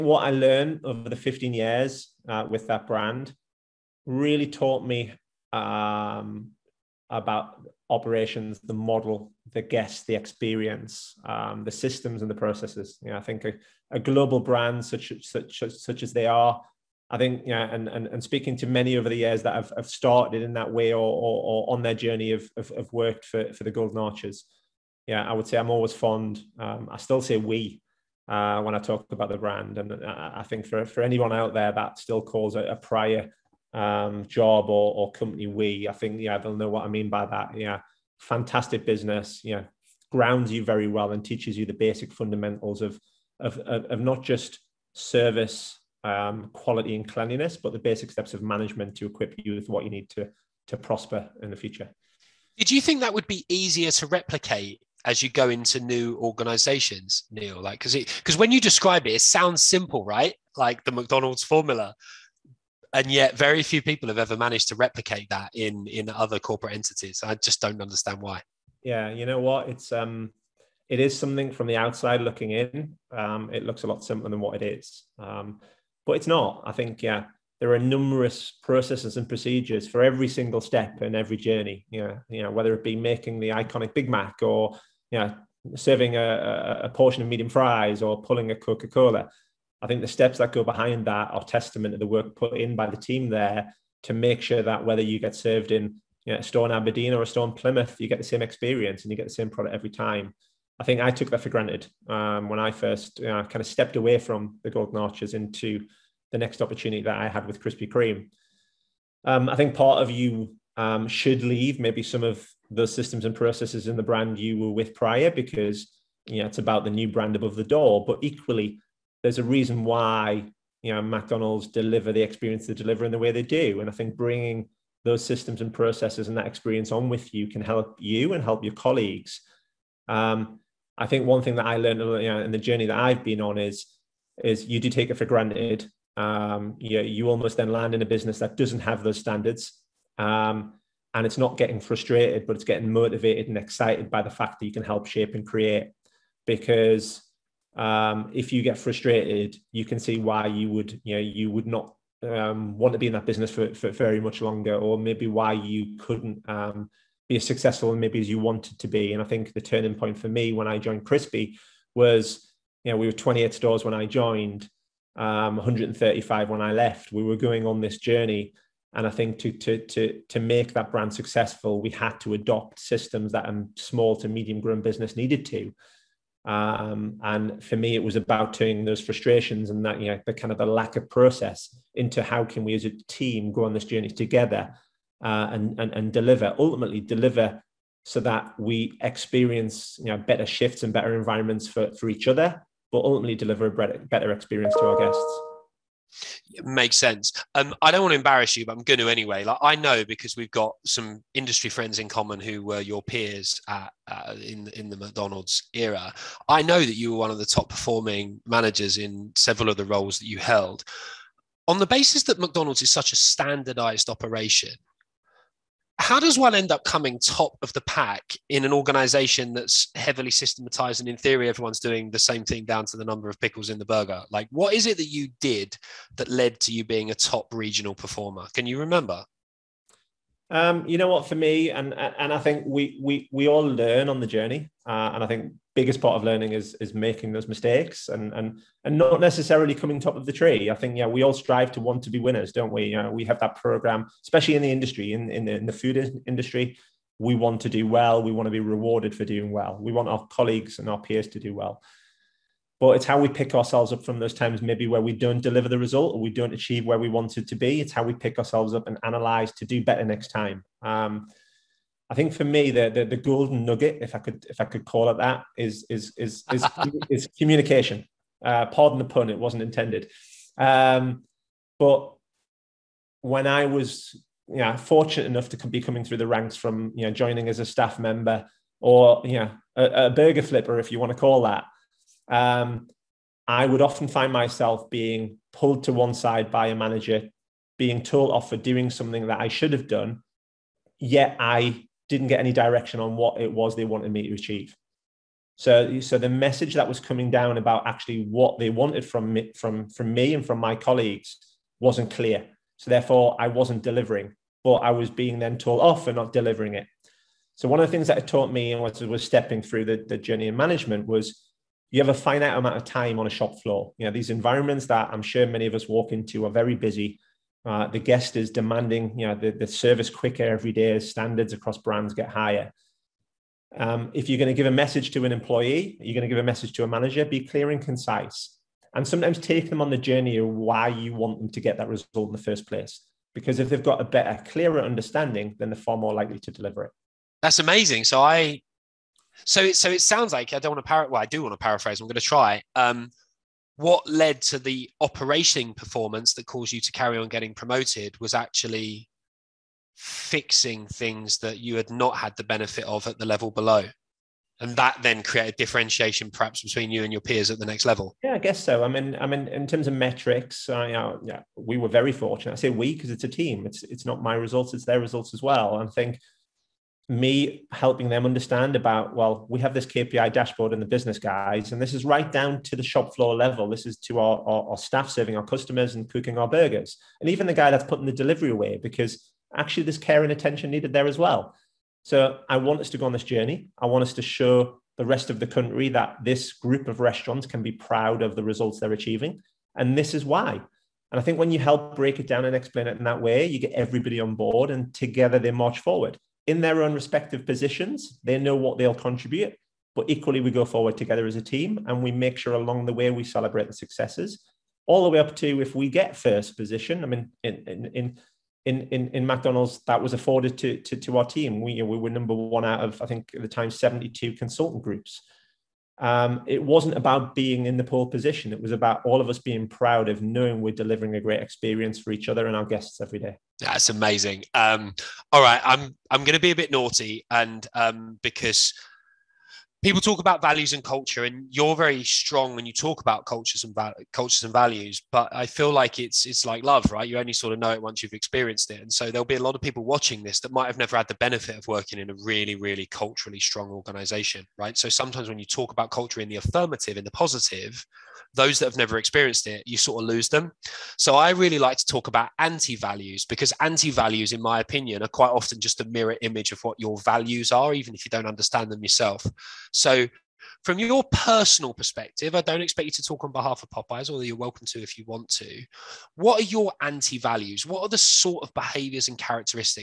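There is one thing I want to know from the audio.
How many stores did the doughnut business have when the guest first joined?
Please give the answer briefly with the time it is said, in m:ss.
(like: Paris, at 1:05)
28, at 2:43.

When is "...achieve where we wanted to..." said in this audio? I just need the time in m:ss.
4:16.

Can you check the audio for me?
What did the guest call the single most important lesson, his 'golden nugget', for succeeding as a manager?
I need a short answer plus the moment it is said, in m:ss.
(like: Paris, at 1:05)
Communication, at 4:27.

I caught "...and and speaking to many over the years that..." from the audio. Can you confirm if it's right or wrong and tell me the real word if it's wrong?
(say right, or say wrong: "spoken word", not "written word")
right.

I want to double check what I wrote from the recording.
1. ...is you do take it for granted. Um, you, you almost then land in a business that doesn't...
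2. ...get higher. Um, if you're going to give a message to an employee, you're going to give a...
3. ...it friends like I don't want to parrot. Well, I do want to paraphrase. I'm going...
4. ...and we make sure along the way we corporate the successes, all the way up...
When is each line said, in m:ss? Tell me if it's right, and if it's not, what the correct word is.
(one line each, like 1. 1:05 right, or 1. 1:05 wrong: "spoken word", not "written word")
1. 2:14 right
2. 5:22 right
3. 5:39 wrong: "sounds", not "friends"
4. 6:41 wrong: "celebrate", not "corporate".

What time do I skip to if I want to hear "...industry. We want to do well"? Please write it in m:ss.
4:06.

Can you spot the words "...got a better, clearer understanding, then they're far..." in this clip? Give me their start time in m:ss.
5:33.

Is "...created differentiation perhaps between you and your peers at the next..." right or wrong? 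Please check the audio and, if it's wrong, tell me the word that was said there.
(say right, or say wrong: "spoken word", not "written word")
right.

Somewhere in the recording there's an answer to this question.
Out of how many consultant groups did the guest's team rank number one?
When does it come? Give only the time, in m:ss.
6:53.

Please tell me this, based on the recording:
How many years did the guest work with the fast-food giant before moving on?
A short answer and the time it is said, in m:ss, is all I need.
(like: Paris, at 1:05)
15 years, at 0:01.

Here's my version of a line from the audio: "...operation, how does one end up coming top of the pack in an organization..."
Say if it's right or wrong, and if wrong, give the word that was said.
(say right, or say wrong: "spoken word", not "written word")
right.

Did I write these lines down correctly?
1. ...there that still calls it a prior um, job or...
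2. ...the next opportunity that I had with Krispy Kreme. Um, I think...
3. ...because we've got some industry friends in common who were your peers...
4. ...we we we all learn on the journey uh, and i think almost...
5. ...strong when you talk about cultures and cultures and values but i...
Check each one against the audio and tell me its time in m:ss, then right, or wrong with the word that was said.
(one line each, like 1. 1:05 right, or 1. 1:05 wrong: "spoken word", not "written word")
1. 0:31 right
2. 1:46 right
3. 3:20 right
4. 3:52 wrong: "biggest", not "almost"
5. 7:12 right.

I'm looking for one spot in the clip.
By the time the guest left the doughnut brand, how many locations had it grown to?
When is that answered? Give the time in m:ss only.
2:45.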